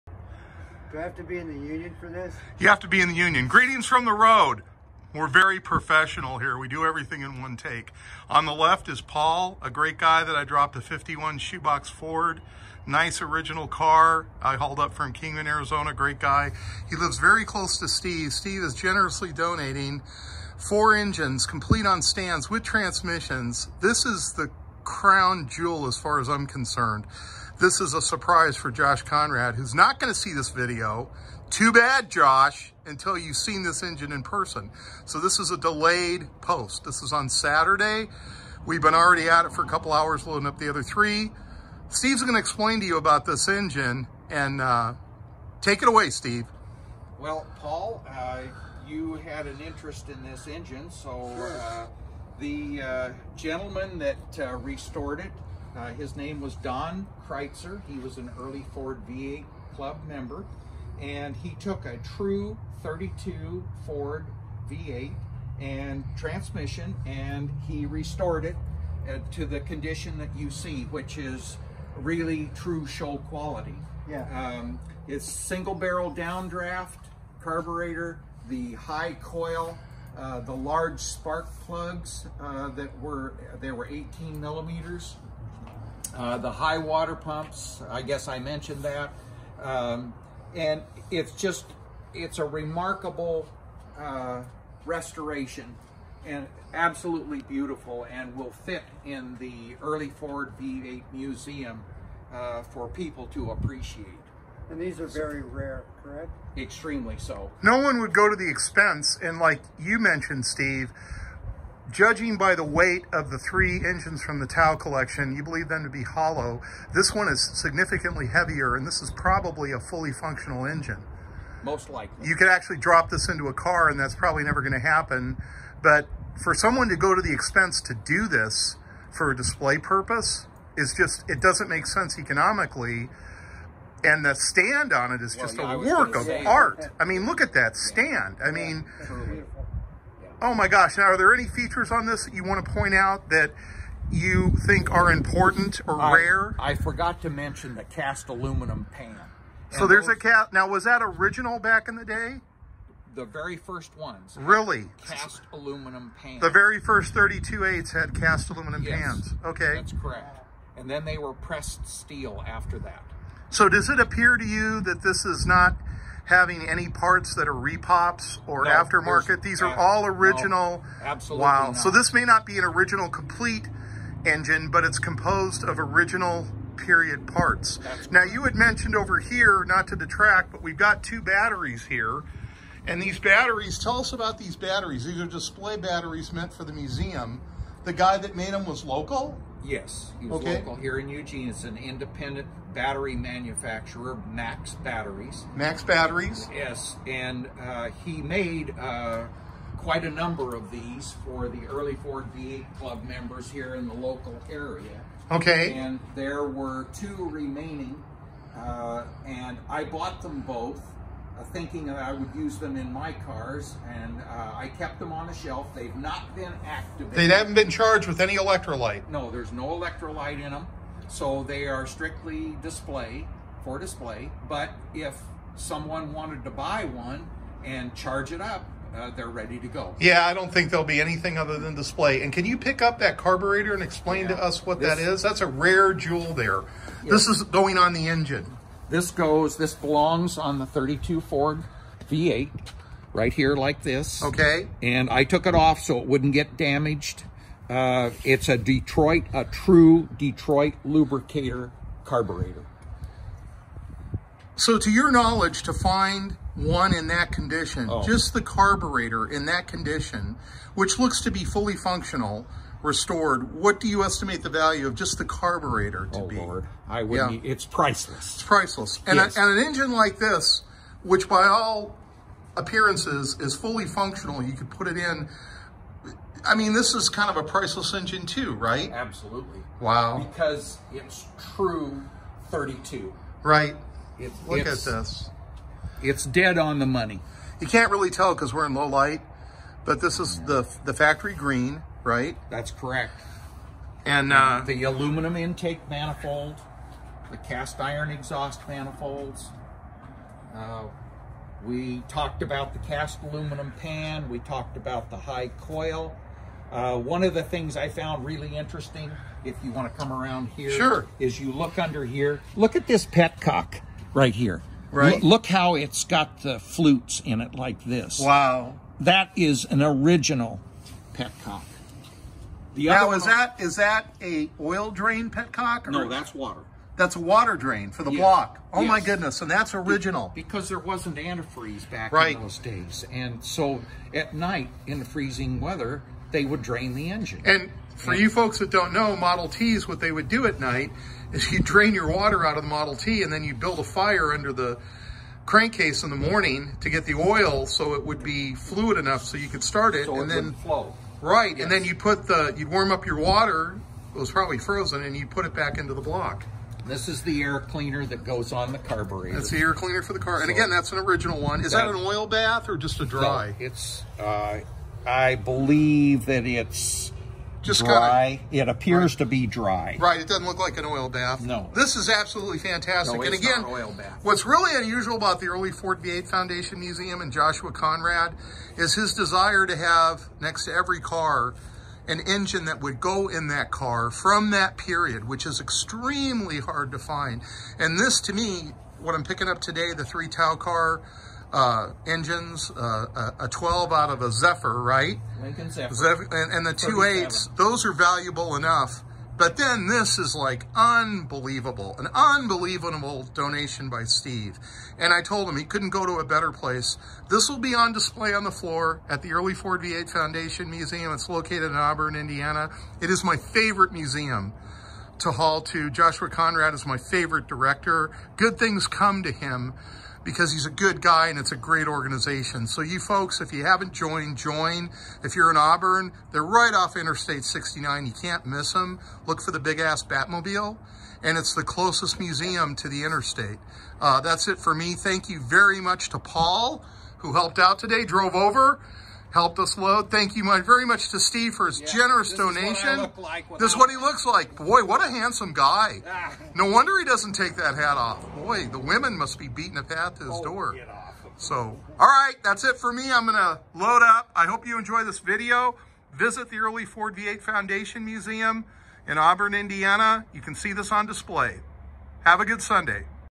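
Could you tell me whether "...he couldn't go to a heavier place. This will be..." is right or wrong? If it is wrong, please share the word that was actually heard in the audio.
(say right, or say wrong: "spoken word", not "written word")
wrong: "better", not "heavier".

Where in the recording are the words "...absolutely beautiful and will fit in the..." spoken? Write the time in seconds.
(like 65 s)
96 s.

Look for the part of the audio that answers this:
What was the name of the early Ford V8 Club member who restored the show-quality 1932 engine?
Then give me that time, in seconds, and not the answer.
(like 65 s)
56 s.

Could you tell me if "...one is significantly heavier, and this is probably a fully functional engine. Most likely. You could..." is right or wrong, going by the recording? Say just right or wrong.
right.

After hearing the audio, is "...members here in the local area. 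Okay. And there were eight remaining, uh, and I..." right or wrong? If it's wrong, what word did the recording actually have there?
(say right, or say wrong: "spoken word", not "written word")
wrong: "two", not "eight".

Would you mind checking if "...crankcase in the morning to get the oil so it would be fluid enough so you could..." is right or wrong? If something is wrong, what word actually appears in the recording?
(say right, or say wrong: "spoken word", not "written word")
right.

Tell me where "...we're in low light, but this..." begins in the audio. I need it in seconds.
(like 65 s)
288 s.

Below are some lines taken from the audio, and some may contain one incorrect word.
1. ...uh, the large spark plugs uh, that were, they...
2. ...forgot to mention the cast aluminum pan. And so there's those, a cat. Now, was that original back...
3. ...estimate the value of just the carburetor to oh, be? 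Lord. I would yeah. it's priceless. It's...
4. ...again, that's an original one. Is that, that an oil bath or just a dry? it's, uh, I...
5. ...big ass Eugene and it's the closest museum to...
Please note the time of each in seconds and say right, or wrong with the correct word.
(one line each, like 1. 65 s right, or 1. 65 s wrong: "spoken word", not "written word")
1. 80 s right
2. 146 s right
3. 264 s right
4. 360 s right
5. 429 s wrong: "Batmobile", not "Eugene".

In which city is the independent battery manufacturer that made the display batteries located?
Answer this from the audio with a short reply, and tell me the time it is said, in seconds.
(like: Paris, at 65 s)
Eugene, at 191 s.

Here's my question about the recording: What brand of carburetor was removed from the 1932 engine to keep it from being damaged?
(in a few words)
Detroit Lubricator.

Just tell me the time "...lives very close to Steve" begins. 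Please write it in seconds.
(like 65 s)
16 s.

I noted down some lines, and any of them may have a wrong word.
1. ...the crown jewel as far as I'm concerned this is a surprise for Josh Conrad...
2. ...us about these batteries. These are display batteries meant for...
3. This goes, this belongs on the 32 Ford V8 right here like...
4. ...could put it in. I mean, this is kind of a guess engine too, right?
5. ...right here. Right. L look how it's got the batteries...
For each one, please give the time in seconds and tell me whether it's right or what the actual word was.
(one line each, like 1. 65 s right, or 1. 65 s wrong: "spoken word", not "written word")
1. 24 s right
2. 183 s right
3. 238 s right
4. 274 s wrong: "priceless", not "guess"
5. 314 s wrong: "flutes", not "batteries".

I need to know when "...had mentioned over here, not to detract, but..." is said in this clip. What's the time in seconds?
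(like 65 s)
178 s.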